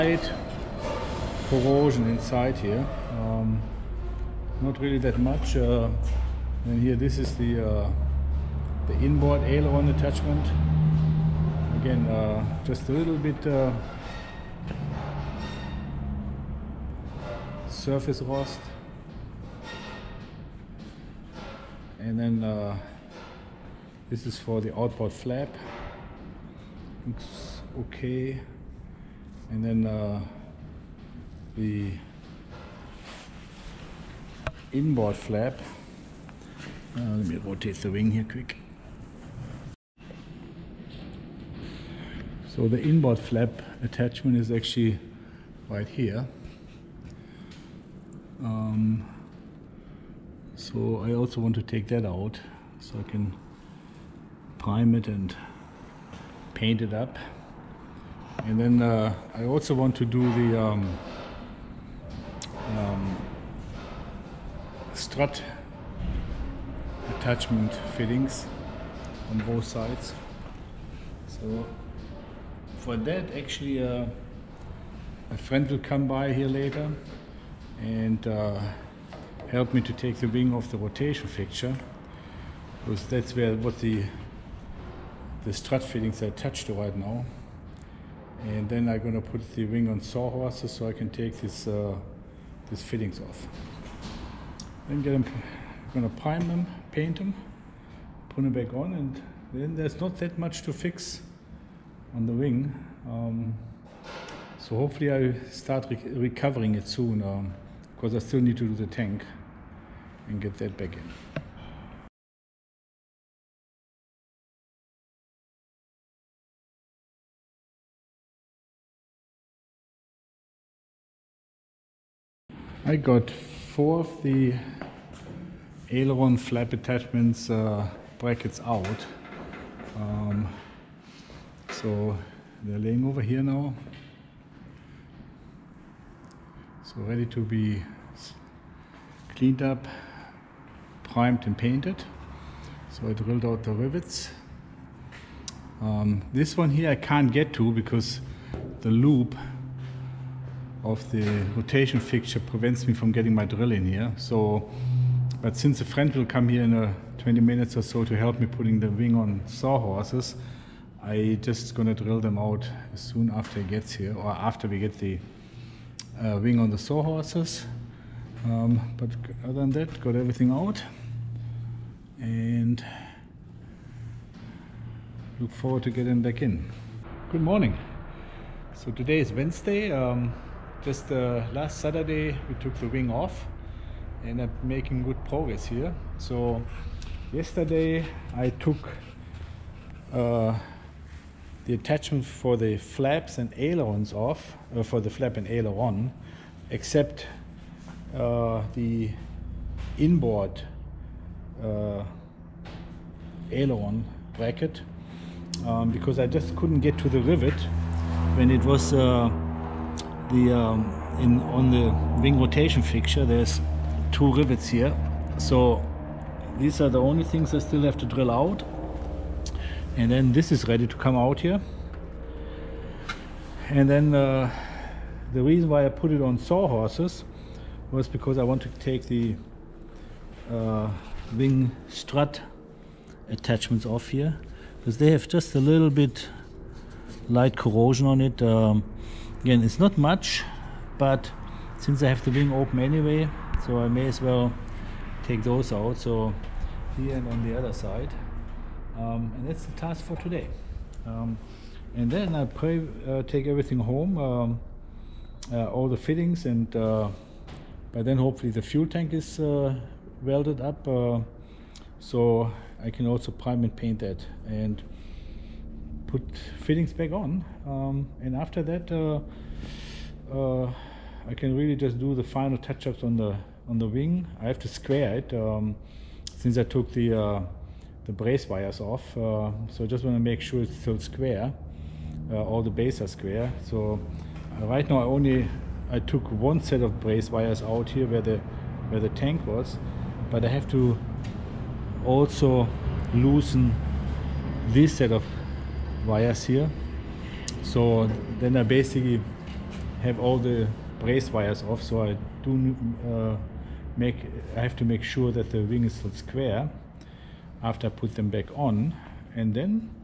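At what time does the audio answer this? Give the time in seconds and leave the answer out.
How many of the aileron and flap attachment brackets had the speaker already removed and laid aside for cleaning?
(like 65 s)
123 s.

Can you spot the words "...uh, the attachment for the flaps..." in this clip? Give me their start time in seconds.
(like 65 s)
190 s.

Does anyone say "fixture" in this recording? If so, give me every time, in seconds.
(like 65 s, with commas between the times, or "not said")
81 s, 151 s, 212 s.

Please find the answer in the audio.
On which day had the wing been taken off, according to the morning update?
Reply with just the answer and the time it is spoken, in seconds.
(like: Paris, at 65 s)
Saturday, at 181 s.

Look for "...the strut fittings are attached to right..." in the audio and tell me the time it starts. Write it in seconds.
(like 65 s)
85 s.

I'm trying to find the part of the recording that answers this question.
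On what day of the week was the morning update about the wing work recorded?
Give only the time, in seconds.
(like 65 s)
179 s.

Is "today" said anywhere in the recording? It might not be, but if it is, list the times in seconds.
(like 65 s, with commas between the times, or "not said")
178 s, 250 s.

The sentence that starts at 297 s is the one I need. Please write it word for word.
So then I basically have all the brace wires off.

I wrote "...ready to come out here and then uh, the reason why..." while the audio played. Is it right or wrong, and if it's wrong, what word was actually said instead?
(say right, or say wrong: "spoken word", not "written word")
right.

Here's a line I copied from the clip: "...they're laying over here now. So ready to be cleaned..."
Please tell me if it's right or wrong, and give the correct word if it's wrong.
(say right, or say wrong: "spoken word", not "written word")
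right.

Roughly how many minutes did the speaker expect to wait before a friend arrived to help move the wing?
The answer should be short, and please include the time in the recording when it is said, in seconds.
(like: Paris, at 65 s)
20, at 157 s.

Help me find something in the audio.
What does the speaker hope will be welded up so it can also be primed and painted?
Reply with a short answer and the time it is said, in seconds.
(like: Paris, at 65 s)
the fuel tank, at 258 s.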